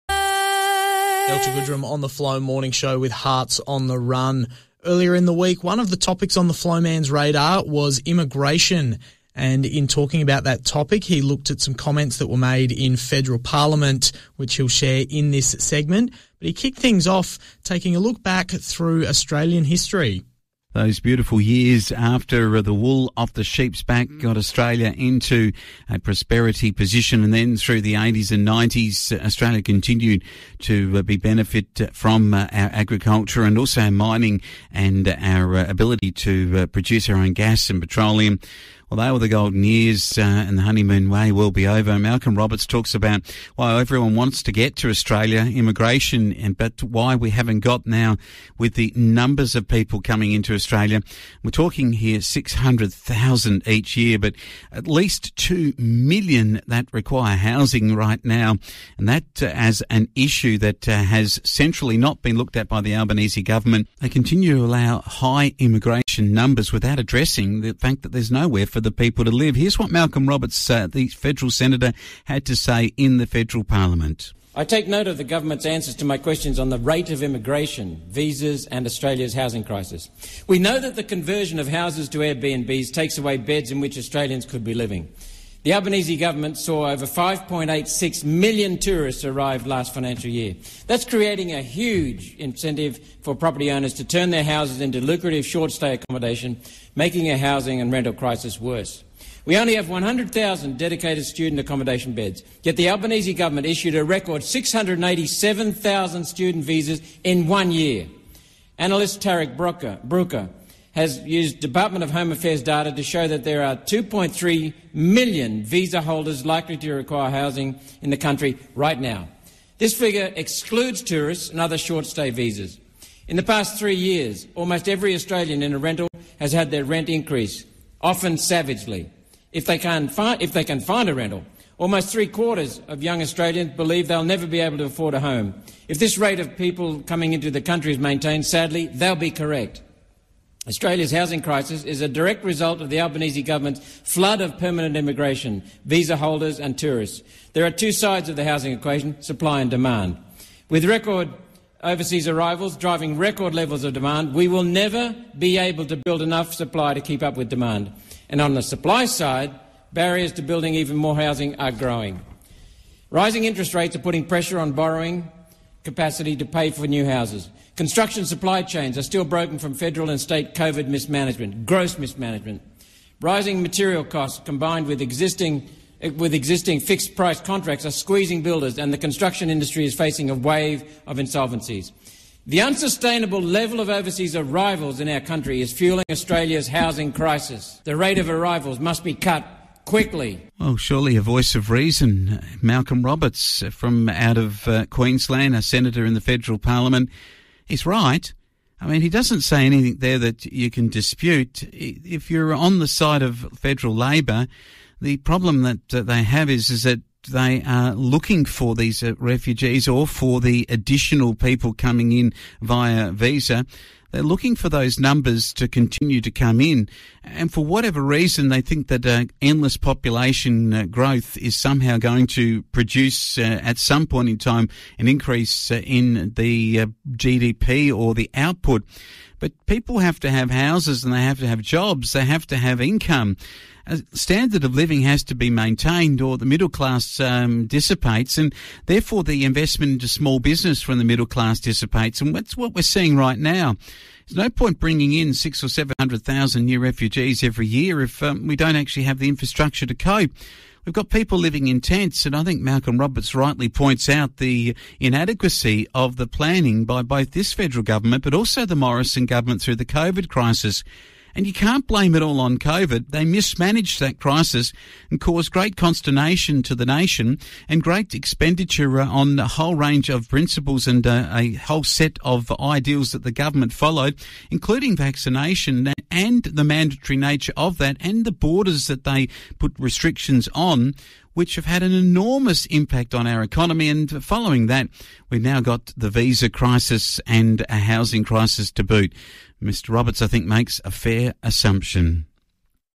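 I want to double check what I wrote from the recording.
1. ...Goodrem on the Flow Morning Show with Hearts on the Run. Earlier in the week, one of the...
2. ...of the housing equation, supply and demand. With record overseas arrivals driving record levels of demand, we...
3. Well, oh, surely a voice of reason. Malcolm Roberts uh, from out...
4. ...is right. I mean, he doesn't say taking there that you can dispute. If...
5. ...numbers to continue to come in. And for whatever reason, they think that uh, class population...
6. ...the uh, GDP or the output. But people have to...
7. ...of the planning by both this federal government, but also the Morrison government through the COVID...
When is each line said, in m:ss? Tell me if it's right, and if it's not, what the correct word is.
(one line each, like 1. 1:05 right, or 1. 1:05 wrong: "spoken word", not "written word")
1. 0:01 right
2. 2:28 right
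3. 3:10 right
4. 3:17 wrong: "anything", not "taking"
5. 3:34 wrong: "endless", not "class"
6. 3:46 right
7. 4:15 right.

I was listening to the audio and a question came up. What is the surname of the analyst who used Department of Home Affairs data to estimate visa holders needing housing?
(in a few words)
Brooker.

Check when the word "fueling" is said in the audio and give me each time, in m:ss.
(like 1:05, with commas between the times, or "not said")
3:05.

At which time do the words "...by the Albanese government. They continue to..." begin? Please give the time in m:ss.
1:02.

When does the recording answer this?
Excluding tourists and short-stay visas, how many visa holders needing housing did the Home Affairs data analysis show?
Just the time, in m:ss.
1:53.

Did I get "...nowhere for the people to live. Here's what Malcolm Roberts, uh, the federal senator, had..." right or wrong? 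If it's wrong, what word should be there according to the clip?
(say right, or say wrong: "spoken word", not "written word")
right.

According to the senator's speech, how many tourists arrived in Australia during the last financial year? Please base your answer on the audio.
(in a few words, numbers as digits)
5.86 million.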